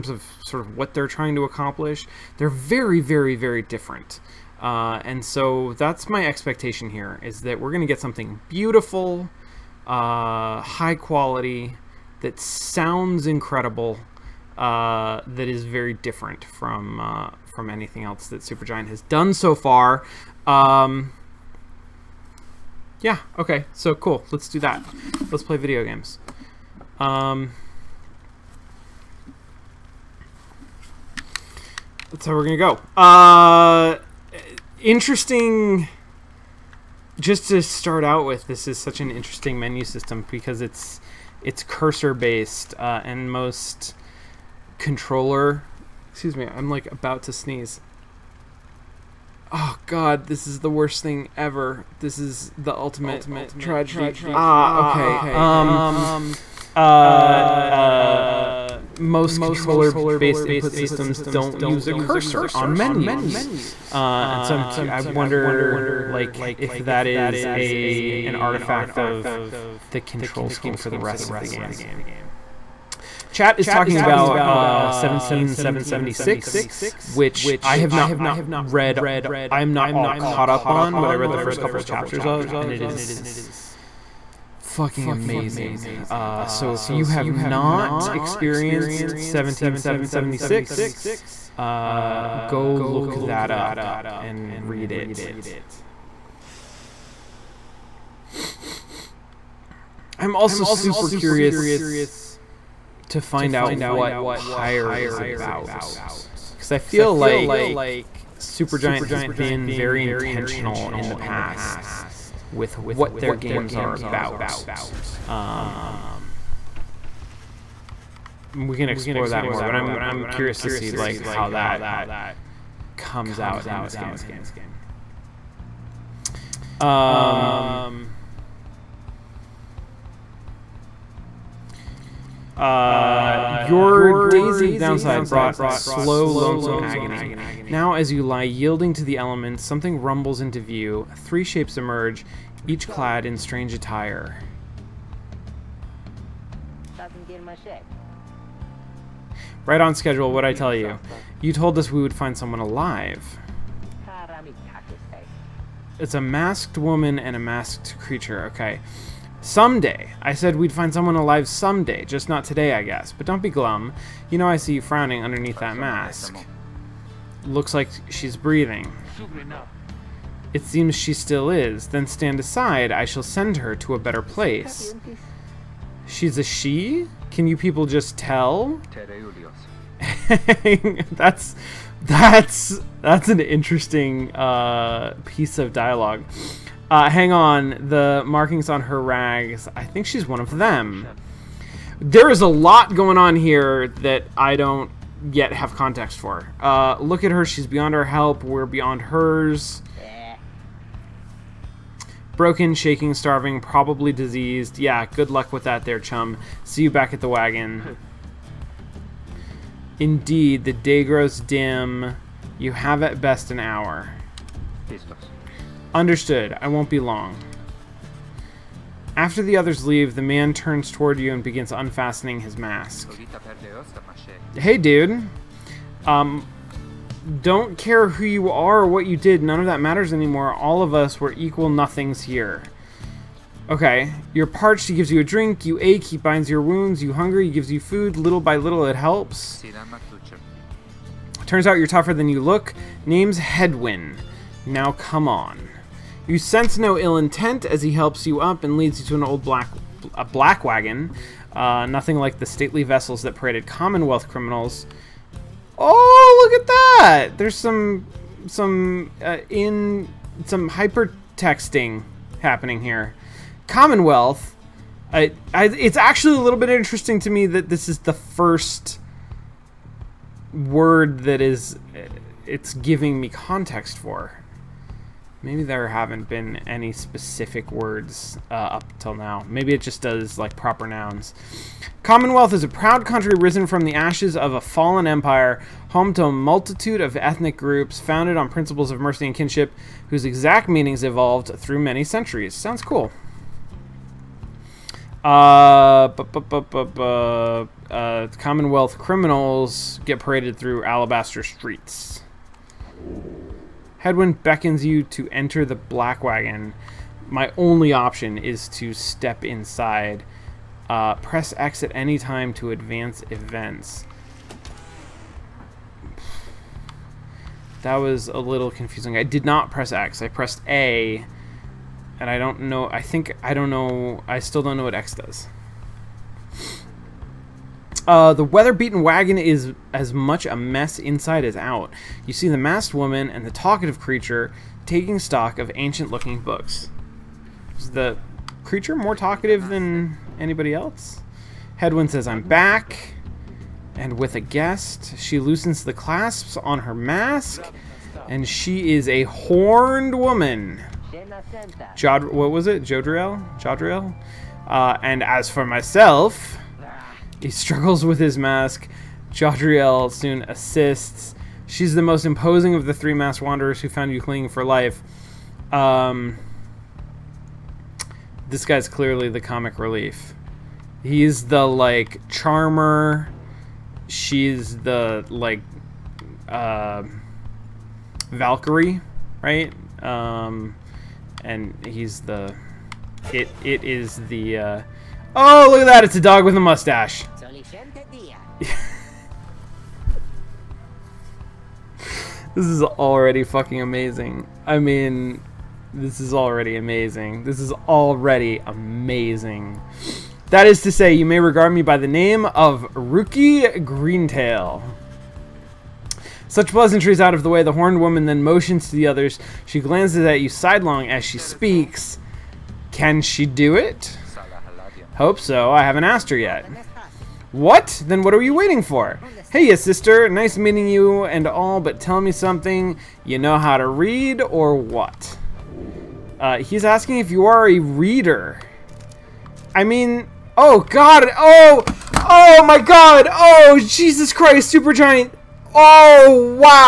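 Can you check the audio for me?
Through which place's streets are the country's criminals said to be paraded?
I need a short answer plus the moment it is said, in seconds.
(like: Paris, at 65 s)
Alabaster, at 300 s.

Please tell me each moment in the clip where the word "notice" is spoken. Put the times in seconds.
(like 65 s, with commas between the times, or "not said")
not said.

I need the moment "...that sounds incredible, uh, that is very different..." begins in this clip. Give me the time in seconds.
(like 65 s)
12 s.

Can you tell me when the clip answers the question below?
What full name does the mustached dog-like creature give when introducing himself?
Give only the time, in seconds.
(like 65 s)
402 s.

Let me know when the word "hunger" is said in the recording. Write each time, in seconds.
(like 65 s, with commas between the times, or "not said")
237 s.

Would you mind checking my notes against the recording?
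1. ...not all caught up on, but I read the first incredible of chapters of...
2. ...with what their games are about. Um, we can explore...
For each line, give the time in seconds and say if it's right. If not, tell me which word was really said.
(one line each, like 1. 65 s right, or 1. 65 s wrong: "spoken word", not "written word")
1. 79 s wrong: "couple", not "incredible"
2. 112 s right.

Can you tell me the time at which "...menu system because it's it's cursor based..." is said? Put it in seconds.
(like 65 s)
39 s.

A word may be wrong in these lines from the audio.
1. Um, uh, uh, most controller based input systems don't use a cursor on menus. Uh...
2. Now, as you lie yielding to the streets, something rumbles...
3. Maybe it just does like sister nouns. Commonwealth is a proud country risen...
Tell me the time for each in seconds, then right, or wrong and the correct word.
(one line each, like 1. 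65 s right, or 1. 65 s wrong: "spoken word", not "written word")
1. 55 s right
2. 137 s wrong: "elements", not "streets"
3. 279 s wrong: "proper", not "sister".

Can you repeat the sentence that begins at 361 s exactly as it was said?
She's the most imposing of the three masked wanderers who found you clinging for life.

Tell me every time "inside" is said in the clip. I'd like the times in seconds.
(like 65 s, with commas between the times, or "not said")
309 s, 330 s.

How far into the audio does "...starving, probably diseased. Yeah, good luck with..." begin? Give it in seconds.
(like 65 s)
203 s.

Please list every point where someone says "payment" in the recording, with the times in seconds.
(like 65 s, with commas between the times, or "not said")
not said.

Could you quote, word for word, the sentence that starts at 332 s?
You see the masked woman and the talkative creature taking stock of ancient-looking books.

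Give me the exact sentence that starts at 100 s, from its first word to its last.
I'm also super curious to find out what Pyre is about.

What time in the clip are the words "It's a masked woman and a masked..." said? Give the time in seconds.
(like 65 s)
155 s.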